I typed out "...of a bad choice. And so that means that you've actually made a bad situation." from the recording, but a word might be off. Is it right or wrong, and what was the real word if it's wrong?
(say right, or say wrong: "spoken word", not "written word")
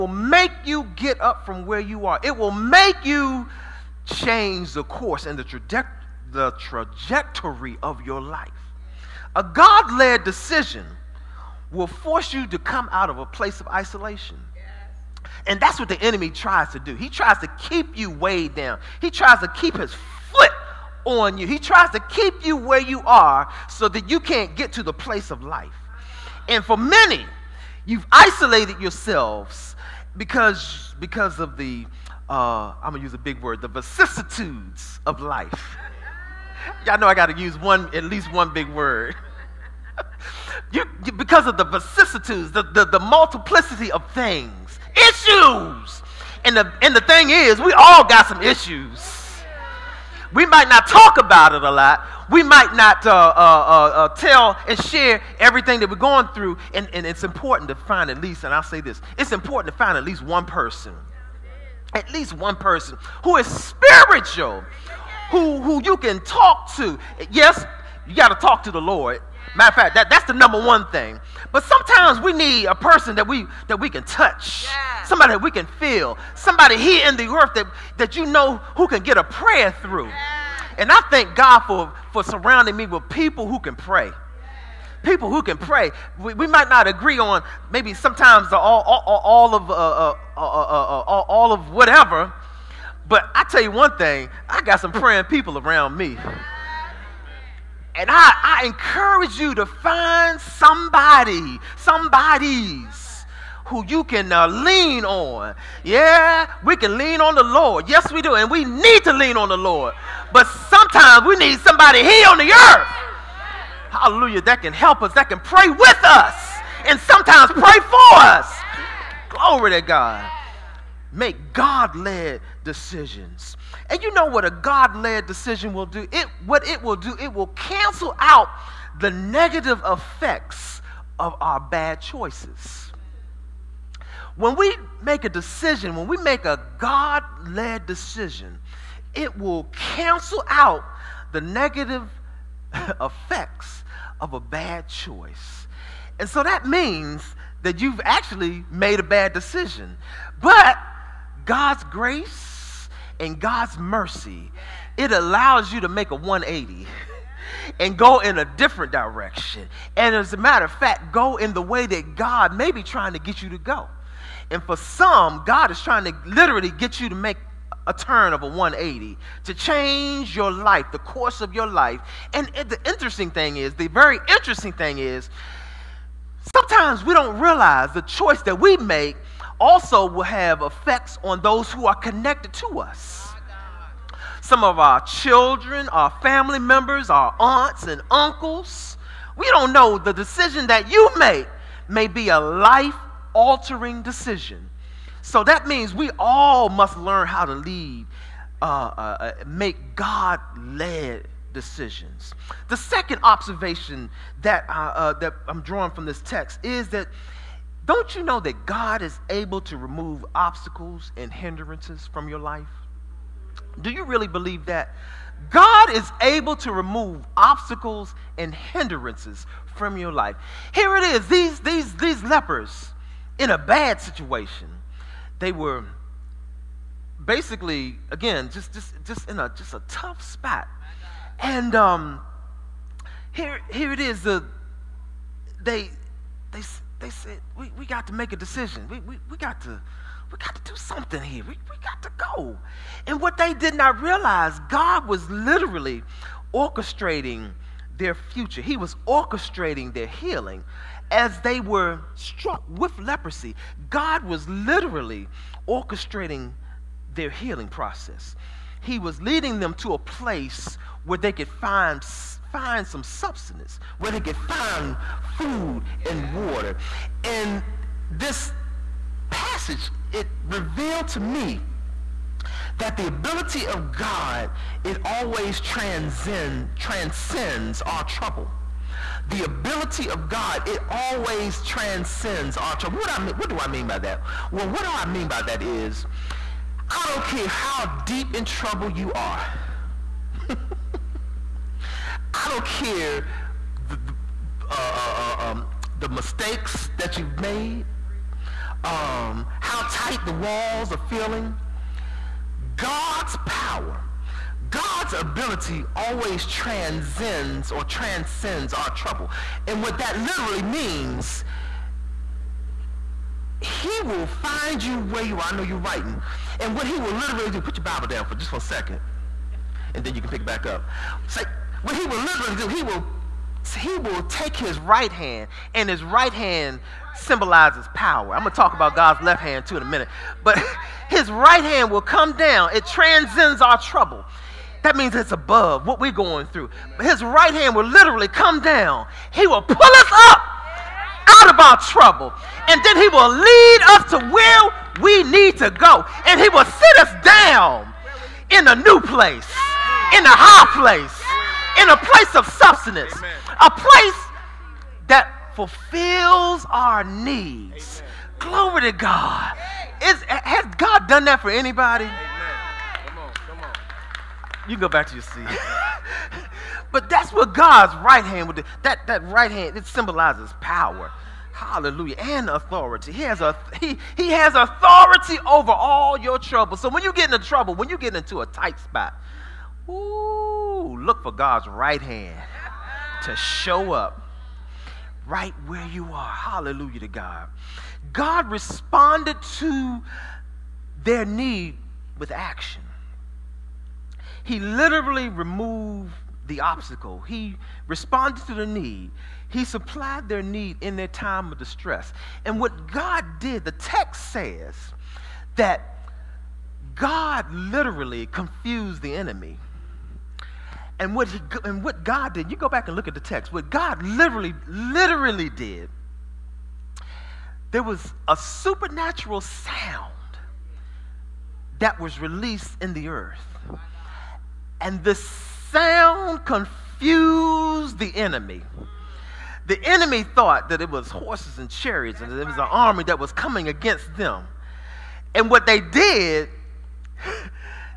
wrong: "decision", not "situation".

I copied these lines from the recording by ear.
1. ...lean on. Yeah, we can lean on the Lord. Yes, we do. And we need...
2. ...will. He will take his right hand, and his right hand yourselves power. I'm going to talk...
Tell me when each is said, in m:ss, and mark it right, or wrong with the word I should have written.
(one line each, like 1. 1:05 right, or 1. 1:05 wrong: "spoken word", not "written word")
1. 1:44 right
2. 5:22 wrong: "symbolizes", not "yourselves".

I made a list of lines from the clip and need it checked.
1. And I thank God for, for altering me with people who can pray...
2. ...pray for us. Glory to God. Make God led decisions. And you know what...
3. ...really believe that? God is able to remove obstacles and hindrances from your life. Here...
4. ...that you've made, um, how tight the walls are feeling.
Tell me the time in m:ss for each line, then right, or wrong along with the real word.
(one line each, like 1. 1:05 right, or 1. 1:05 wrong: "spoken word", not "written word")
1. 1:20 wrong: "surrounding", not "altering"
2. 1:57 right
3. 3:34 right
4. 4:56 right.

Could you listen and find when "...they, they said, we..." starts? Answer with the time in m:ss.
3:56.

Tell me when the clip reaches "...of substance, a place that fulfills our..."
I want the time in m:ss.
5:52.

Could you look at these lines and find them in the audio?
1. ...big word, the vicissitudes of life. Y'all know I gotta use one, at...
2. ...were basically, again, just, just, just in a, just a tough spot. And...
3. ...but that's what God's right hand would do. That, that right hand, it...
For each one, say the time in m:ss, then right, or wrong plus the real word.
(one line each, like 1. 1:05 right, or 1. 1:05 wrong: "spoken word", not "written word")
1. 0:33 right
2. 3:45 right
3. 6:06 right.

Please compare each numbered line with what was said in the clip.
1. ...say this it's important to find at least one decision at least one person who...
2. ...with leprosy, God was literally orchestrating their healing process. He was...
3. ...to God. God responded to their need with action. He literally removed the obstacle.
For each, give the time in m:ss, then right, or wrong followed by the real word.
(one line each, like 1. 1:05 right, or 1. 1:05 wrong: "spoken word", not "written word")
1. 0:58 wrong: "person", not "decision"
2. 4:12 right
3. 6:26 right.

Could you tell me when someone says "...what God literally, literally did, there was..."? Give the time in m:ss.
6:53.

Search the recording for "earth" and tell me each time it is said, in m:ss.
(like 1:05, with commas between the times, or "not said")
1:17, 1:52, 7:03.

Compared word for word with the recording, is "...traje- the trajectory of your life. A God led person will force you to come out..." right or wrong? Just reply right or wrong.
wrong.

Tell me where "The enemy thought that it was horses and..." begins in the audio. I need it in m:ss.
7:09.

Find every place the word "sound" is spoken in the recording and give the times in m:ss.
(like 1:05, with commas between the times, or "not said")
6:59, 7:05.